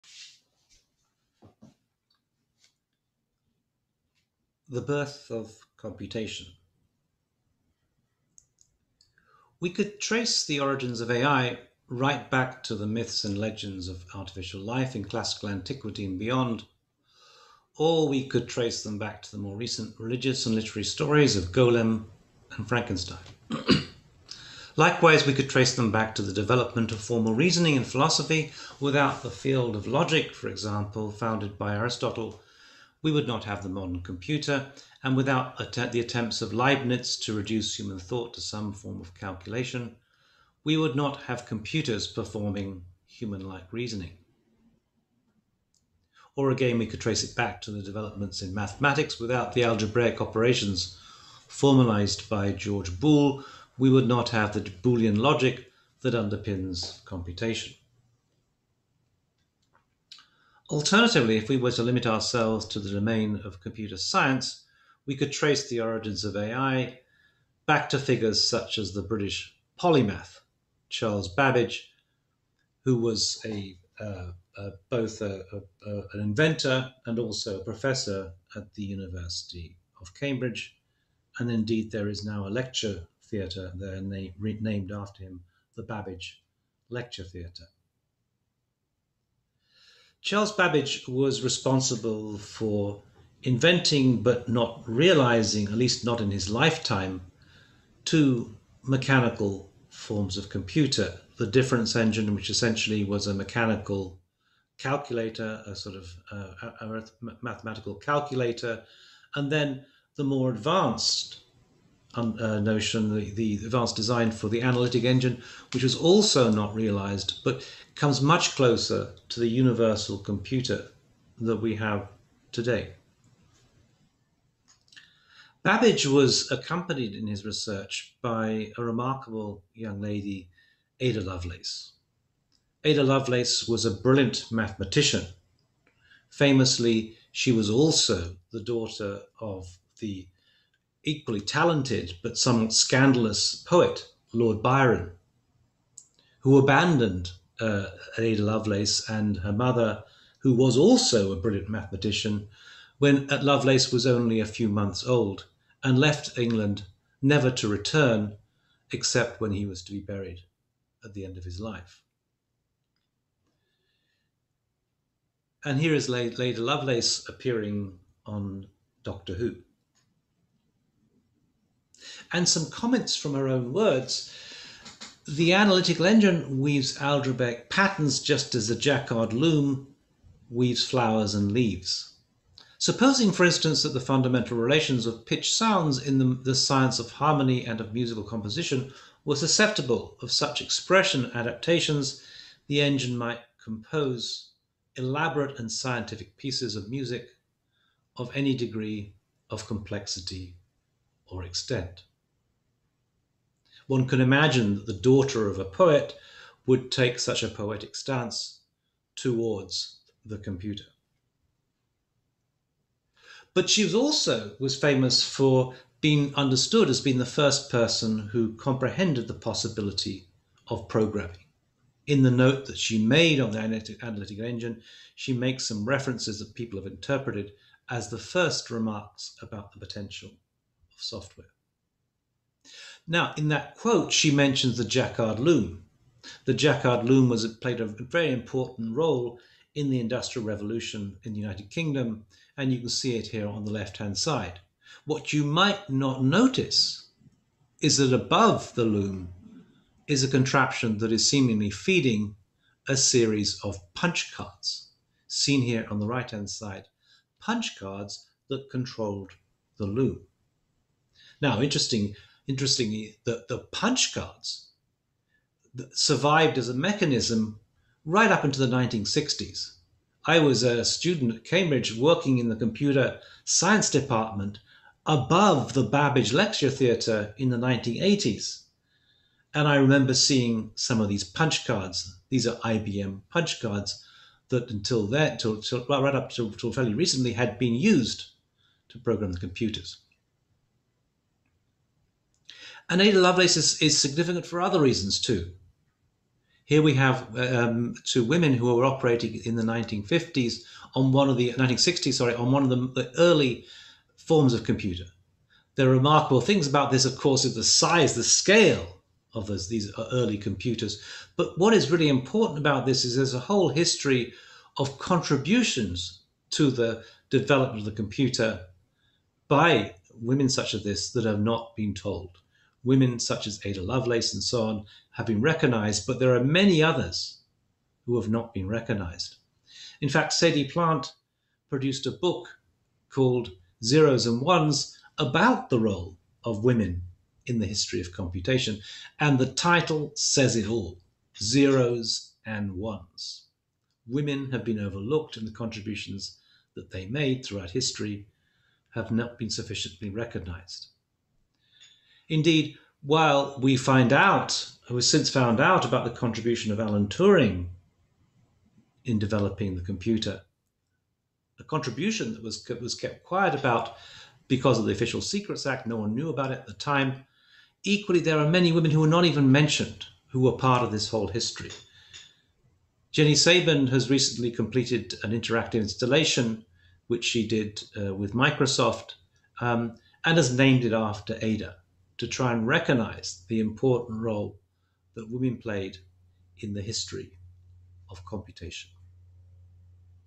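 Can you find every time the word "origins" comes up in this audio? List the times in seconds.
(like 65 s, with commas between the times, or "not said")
10 s, 65 s.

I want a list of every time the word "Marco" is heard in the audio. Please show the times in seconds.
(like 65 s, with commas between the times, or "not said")
not said.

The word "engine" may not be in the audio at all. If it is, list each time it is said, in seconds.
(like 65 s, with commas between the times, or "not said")
101 s, 115 s, 176 s, 192 s, 224 s.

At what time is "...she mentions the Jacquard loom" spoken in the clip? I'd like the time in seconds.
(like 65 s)
234 s.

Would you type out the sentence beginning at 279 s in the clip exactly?
And I remember seeing some of these punch cards.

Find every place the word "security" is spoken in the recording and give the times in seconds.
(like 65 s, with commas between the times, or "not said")
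not said.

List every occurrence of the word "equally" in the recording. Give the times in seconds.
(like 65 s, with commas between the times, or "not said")
141 s, 367 s.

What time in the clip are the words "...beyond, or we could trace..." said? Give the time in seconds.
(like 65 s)
16 s.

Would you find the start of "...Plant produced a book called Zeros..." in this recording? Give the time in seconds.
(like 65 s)
330 s.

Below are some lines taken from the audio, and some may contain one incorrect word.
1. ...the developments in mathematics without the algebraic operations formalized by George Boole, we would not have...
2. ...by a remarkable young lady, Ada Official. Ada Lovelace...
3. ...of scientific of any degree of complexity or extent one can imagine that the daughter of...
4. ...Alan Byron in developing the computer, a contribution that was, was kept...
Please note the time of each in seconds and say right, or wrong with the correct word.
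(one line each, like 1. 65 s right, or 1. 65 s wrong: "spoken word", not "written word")
1. 47 s right
2. 128 s wrong: "Lovelace", not "Official"
3. 196 s wrong: "music", not "scientific"
4. 356 s wrong: "Turing", not "Byron".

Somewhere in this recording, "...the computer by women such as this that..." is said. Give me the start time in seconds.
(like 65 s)
317 s.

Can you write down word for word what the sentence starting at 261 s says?
Now, interesting interestingly, the, the punch cards survived as a mechanism right up into the 1960s.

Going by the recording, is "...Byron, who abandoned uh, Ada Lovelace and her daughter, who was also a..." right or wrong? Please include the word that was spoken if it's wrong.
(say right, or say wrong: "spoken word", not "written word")
wrong: "mother", not "daughter".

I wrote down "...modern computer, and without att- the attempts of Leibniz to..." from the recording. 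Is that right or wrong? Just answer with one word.
right.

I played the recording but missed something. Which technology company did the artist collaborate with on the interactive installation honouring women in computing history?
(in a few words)
Microsoft.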